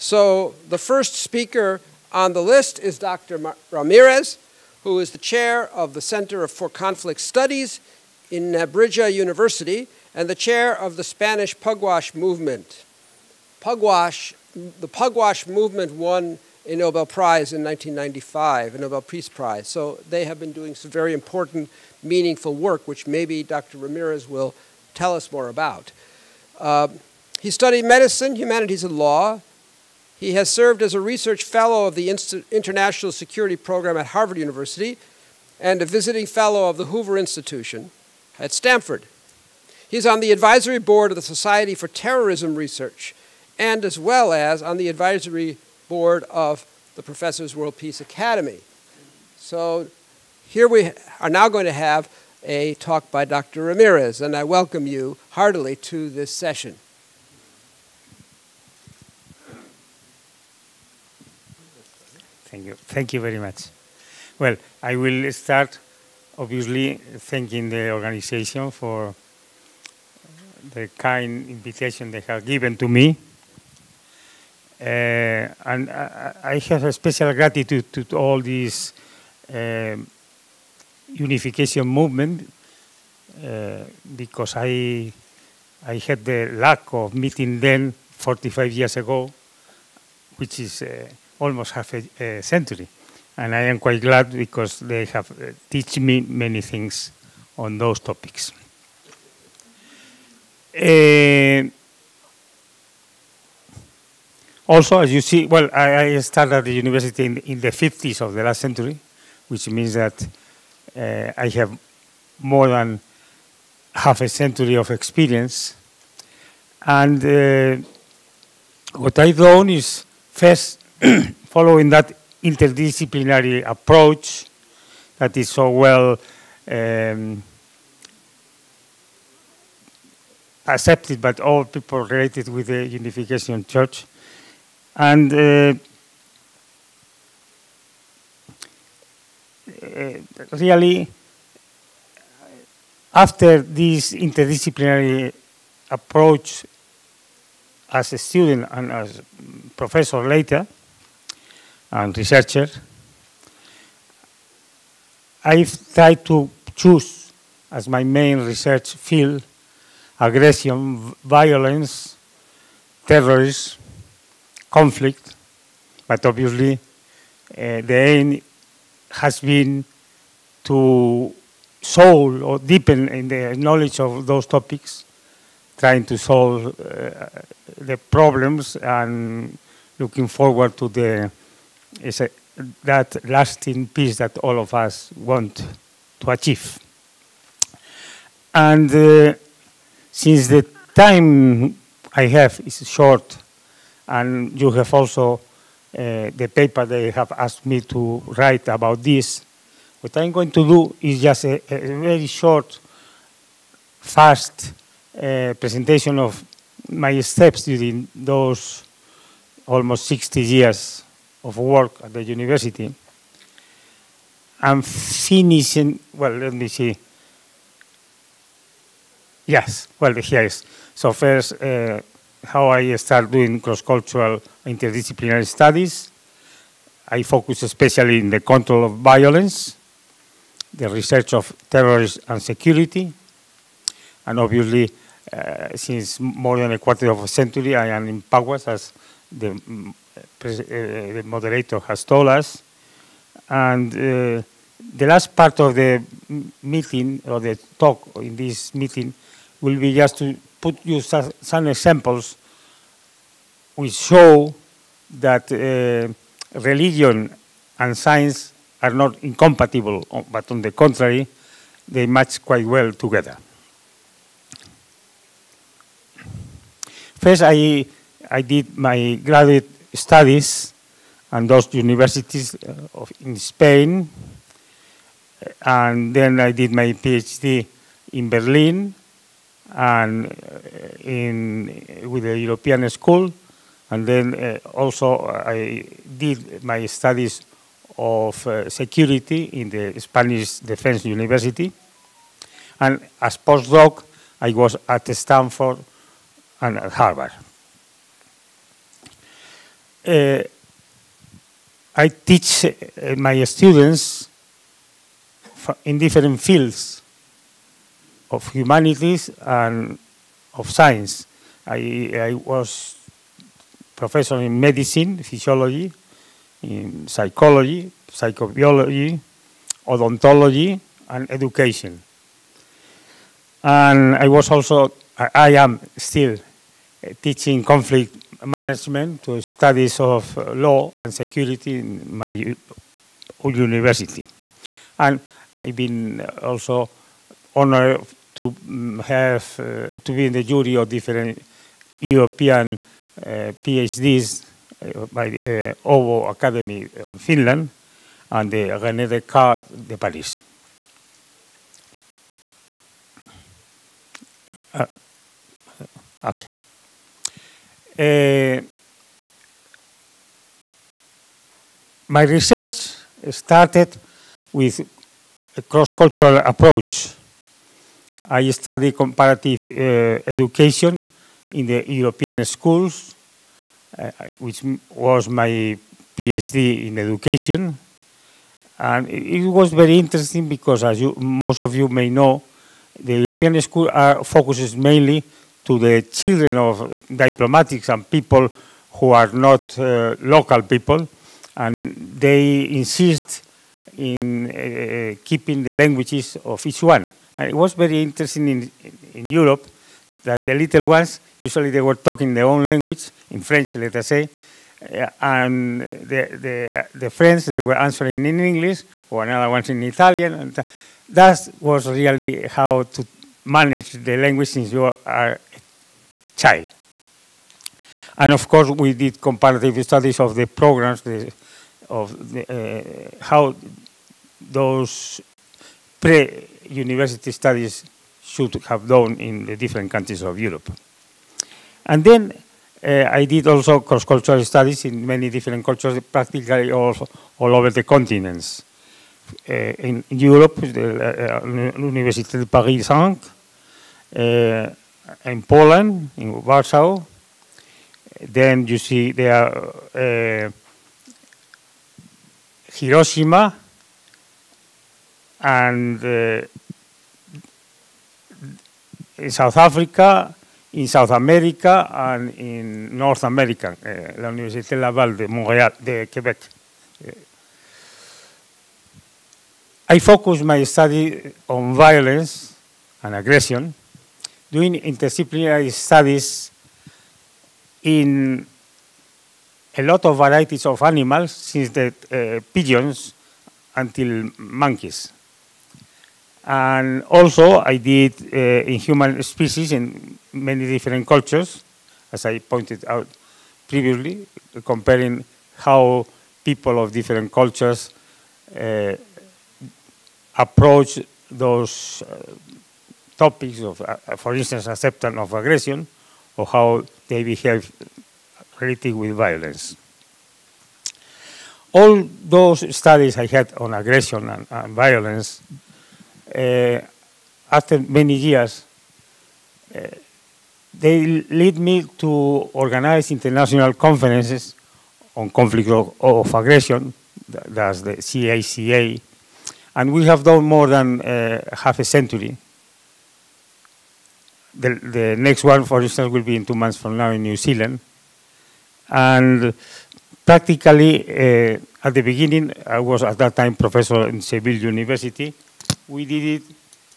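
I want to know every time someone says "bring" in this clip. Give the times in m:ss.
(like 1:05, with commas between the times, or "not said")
not said.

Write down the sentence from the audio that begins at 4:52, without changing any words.
And as postdoc, I was at Stanford and at Harvard.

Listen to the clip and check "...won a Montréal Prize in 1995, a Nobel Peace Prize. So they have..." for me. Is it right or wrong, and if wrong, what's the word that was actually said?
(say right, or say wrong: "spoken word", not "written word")
wrong: "Nobel", not "Montréal".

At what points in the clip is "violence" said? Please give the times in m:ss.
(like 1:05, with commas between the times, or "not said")
2:41, 3:48, 7:51, 8:29, 8:34.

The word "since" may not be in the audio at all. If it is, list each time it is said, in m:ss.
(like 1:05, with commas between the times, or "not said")
3:10, 3:55, 6:54, 8:01.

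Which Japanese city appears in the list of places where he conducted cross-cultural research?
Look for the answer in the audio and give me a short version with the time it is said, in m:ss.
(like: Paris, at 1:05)
Hiroshima, at 7:32.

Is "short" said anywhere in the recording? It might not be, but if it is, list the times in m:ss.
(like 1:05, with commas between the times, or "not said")
3:12, 3:22.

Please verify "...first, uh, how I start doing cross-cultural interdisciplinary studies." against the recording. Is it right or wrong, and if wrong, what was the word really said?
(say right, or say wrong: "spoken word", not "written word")
right.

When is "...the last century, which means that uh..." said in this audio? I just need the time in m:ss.
1:48.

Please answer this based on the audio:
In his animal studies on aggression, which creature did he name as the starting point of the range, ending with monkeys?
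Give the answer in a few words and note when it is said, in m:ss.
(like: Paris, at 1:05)
Pigeons, at 8:02.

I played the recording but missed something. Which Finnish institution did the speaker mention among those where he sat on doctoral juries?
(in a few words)
Åbo Academy.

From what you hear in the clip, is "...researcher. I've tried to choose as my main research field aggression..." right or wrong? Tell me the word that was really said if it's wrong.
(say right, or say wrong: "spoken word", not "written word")
right.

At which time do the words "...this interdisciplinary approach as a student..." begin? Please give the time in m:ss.
2:23.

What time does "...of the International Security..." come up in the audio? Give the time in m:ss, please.
0:31.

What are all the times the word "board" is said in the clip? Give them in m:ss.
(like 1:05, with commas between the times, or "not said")
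0:40, 0:45.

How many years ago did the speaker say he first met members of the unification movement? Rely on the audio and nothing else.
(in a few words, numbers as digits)
45.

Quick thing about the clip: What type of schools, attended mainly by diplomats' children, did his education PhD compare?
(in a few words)
European schools.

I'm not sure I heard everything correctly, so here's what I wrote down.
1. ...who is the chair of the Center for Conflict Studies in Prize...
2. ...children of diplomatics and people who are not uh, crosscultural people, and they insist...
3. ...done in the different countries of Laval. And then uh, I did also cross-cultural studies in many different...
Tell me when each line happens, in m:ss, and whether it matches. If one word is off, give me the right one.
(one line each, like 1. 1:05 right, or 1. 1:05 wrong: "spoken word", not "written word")
1. 0:04 wrong: "Nebrija", not "Prize"
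2. 6:26 wrong: "local", not "crosscultural"
3. 7:08 wrong: "Europe", not "Laval".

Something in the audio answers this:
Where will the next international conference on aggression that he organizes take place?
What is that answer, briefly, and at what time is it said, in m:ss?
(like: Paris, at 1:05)
New Zealand, at 8:57.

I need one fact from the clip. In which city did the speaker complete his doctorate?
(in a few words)
Berlin.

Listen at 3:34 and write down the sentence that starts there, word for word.
I'm finishing, well, let me see.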